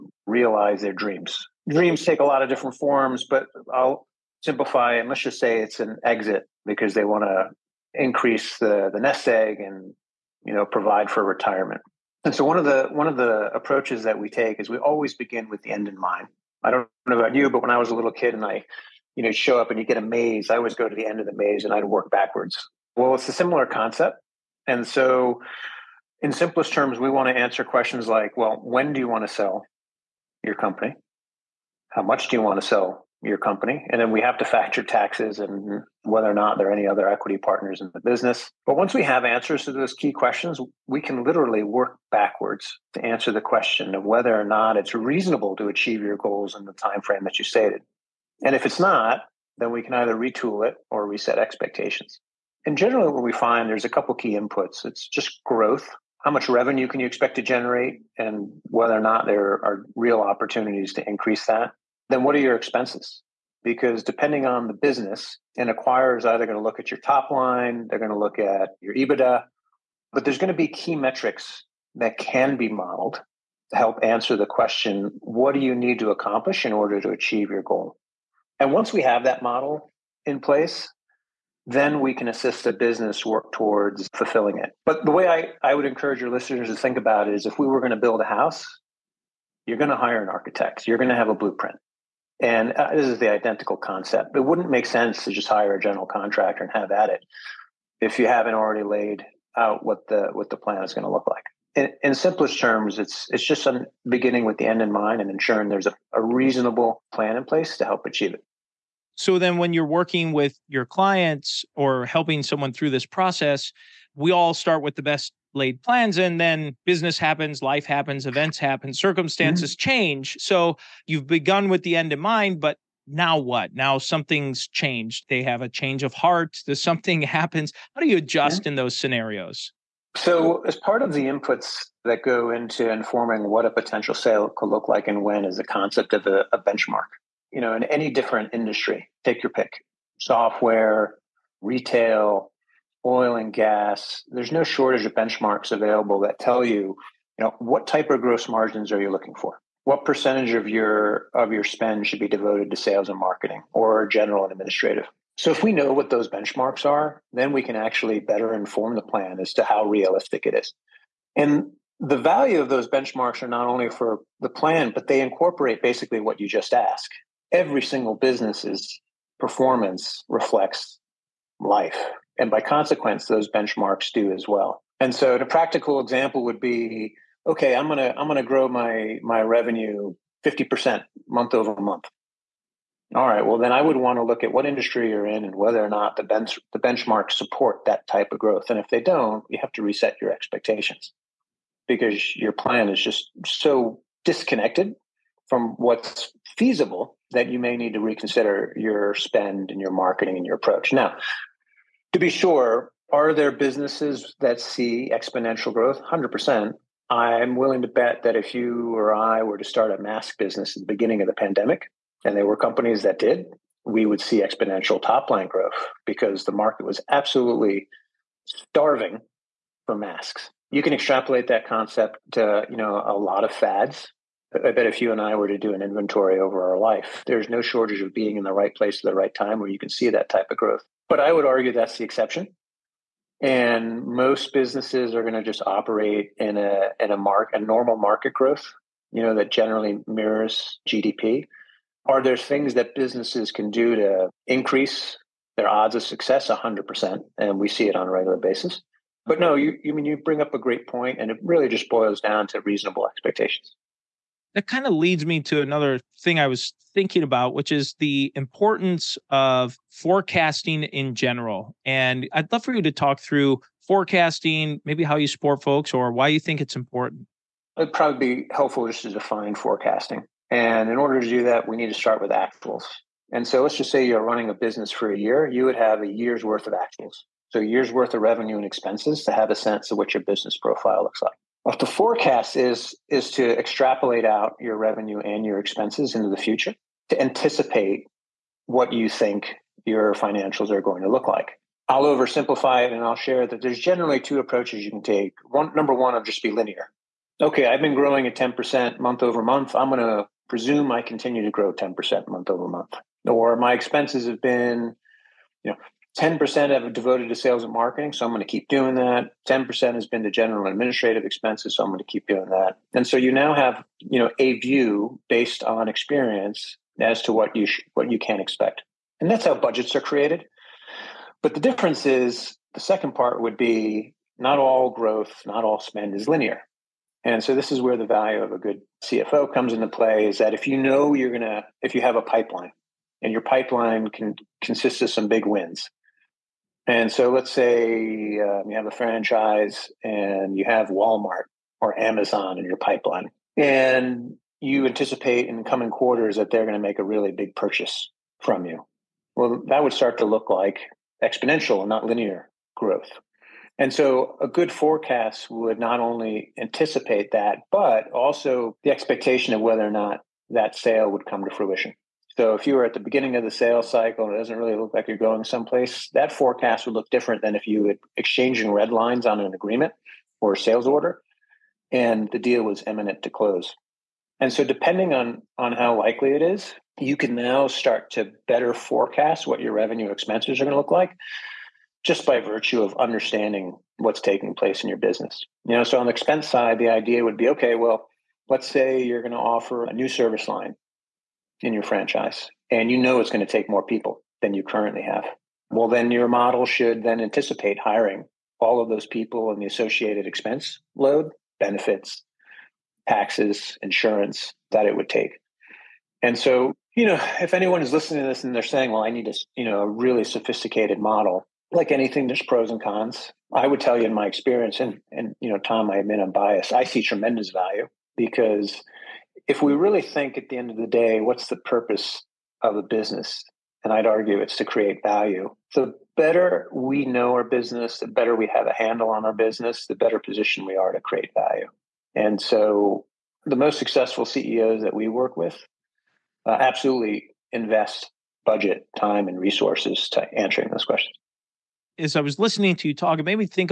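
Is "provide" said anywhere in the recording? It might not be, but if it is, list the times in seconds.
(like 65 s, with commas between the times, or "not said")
10 s.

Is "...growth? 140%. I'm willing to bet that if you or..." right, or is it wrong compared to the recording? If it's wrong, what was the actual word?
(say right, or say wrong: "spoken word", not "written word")
wrong: "100", not "140".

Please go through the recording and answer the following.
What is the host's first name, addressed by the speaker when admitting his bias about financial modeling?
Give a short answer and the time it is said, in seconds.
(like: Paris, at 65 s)
Tom, at 415 s.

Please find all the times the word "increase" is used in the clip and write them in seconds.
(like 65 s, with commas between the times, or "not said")
7 s, 61 s, 244 s.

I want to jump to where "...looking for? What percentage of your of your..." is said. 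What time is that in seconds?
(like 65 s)
149 s.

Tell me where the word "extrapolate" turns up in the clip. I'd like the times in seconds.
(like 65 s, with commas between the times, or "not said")
220 s, 283 s.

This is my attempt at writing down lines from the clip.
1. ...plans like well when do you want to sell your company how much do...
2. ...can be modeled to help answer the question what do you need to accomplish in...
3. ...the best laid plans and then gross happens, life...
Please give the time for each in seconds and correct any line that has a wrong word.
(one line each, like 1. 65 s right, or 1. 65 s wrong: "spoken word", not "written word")
1. 27 s wrong: "questions", not "plans"
2. 72 s right
3. 114 s wrong: "business", not "gross".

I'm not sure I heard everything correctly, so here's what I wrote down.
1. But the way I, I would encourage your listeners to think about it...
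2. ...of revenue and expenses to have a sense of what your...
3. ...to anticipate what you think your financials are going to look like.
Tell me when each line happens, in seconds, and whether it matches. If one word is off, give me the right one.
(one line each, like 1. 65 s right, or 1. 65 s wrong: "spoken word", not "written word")
1. 84 s right
2. 278 s right
3. 287 s right.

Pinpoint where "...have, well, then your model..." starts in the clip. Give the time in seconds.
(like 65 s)
395 s.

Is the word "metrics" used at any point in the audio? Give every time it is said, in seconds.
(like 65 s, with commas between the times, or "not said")
70 s.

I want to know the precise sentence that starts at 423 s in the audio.
And I'd argue it's to create value.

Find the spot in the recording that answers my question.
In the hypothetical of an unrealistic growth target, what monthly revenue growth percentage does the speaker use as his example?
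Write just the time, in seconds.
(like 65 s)
180 s.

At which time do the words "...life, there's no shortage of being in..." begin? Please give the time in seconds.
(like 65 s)
226 s.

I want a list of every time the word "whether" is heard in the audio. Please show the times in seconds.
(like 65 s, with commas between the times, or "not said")
36 s, 44 s, 58 s, 185 s, 359 s.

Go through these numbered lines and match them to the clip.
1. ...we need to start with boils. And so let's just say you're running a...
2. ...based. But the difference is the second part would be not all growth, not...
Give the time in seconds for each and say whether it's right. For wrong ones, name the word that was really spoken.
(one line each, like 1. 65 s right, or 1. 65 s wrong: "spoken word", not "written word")
1. 271 s wrong: "actuals", not "boils"
2. 319 s wrong: "created", not "based".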